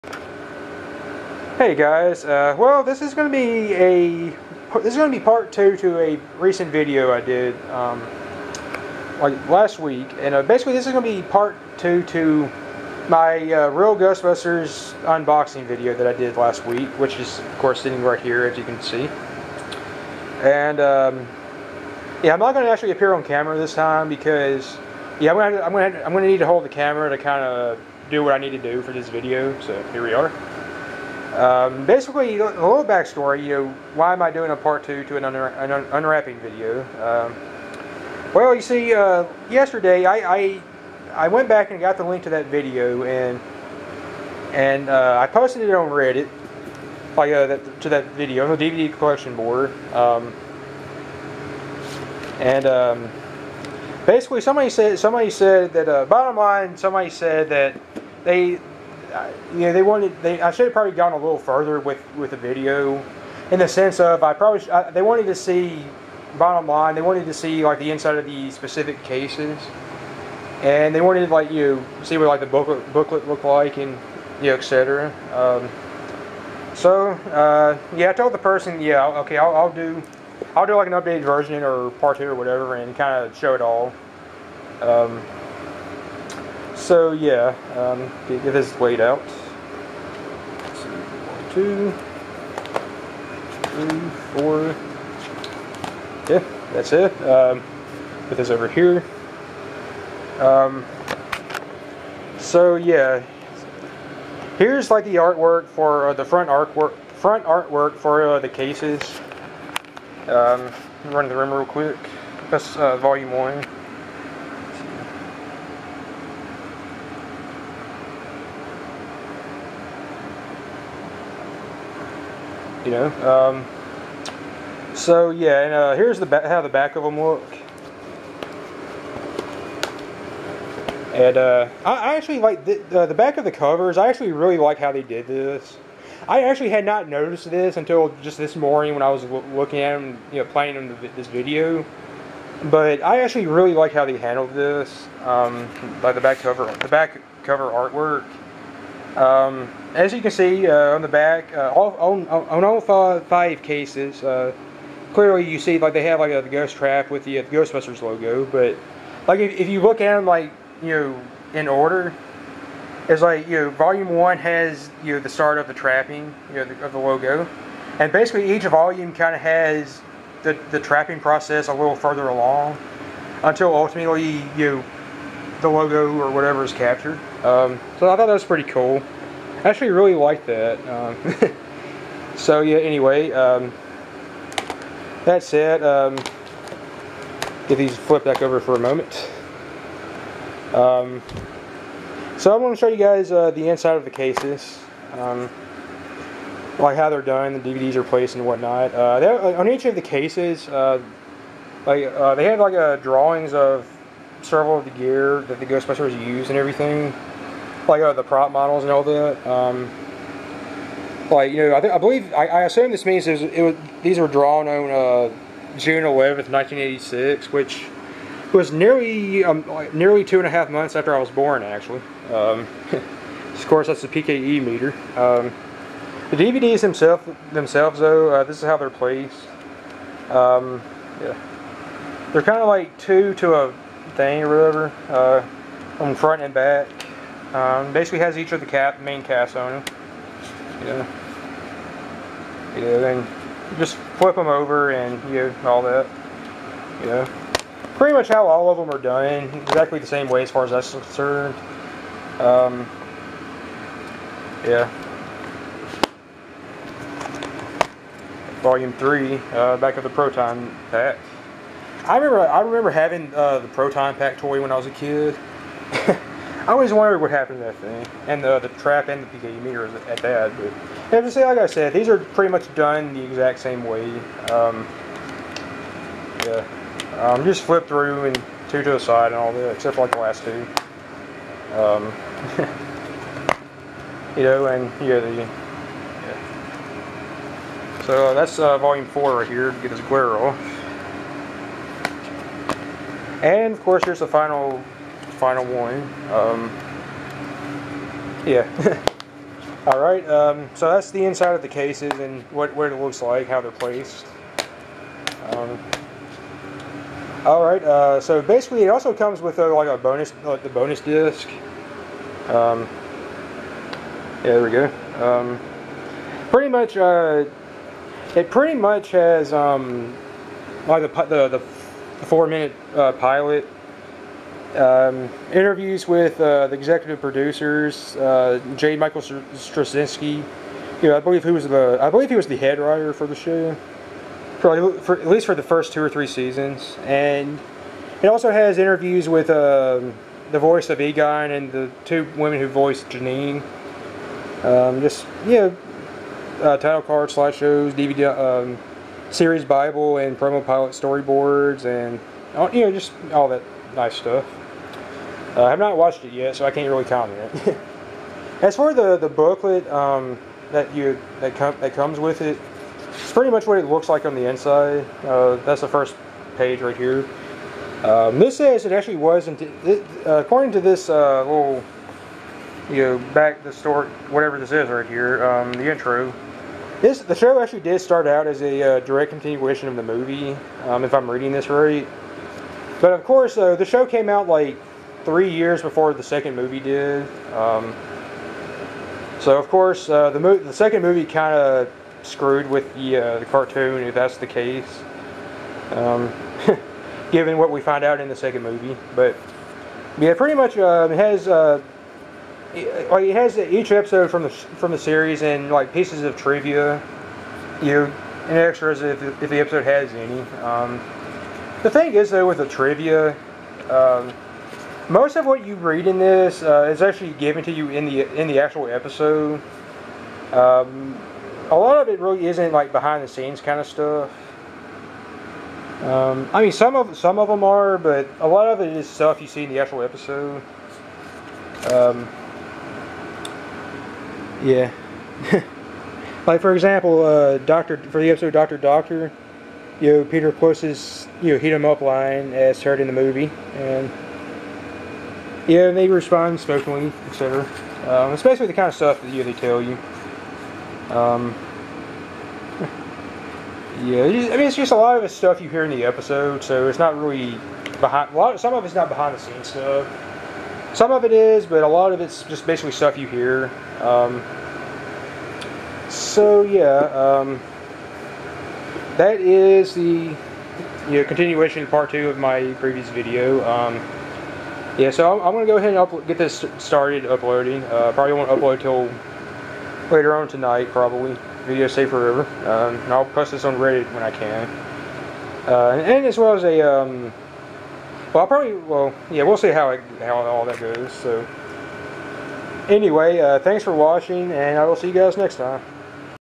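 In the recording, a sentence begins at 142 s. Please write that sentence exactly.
But I actually really like how they handled this, um, the back cover, the back cover artwork.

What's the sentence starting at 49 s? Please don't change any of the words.
Um, and um, basically, somebody said somebody said that uh, bottom line, somebody said that they, uh, you know, they wanted.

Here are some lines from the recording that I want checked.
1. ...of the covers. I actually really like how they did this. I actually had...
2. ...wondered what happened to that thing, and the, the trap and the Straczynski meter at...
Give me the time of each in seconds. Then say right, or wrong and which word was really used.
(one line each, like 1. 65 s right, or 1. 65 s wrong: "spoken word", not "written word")
1. 133 s right
2. 266 s wrong: "PKE", not "Straczynski".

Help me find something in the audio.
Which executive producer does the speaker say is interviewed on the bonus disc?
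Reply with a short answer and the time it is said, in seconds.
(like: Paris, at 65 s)
J. Michael Straczynski, at 328 s.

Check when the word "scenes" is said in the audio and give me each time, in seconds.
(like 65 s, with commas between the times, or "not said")
423 s, 459 s.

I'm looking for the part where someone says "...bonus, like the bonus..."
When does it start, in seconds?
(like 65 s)
309 s.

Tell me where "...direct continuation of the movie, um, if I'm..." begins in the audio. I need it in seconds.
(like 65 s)
379 s.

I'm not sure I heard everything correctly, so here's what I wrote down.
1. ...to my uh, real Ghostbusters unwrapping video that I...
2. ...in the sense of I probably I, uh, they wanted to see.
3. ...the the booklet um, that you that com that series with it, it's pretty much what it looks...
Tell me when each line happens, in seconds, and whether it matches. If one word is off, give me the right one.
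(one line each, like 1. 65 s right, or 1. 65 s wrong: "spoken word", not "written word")
1. 12 s wrong: "unboxing", not "unwrapping"
2. 63 s right
3. 358 s wrong: "comes", not "series".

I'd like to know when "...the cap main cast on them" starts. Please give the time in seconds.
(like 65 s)
238 s.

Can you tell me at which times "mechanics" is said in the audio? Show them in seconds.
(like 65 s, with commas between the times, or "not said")
not said.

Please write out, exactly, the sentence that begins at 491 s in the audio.
So, anyway, uh, thanks for watching, and I will see you guys next time.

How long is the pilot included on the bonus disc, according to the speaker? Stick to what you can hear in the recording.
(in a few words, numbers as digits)
4 minutes.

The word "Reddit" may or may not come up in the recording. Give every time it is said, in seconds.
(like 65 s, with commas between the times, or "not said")
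45 s, 483 s.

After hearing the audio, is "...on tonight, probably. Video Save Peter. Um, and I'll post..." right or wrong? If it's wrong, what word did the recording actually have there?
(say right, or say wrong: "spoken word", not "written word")
wrong: "Forever", not "Peter".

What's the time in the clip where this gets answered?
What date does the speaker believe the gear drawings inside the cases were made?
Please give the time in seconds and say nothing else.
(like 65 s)
215 s.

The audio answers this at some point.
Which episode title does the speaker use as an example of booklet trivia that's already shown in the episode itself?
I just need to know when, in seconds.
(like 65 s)
438 s.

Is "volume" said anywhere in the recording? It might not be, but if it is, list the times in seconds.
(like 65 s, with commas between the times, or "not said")
112 s, 163 s, 168 s, 258 s, 288 s.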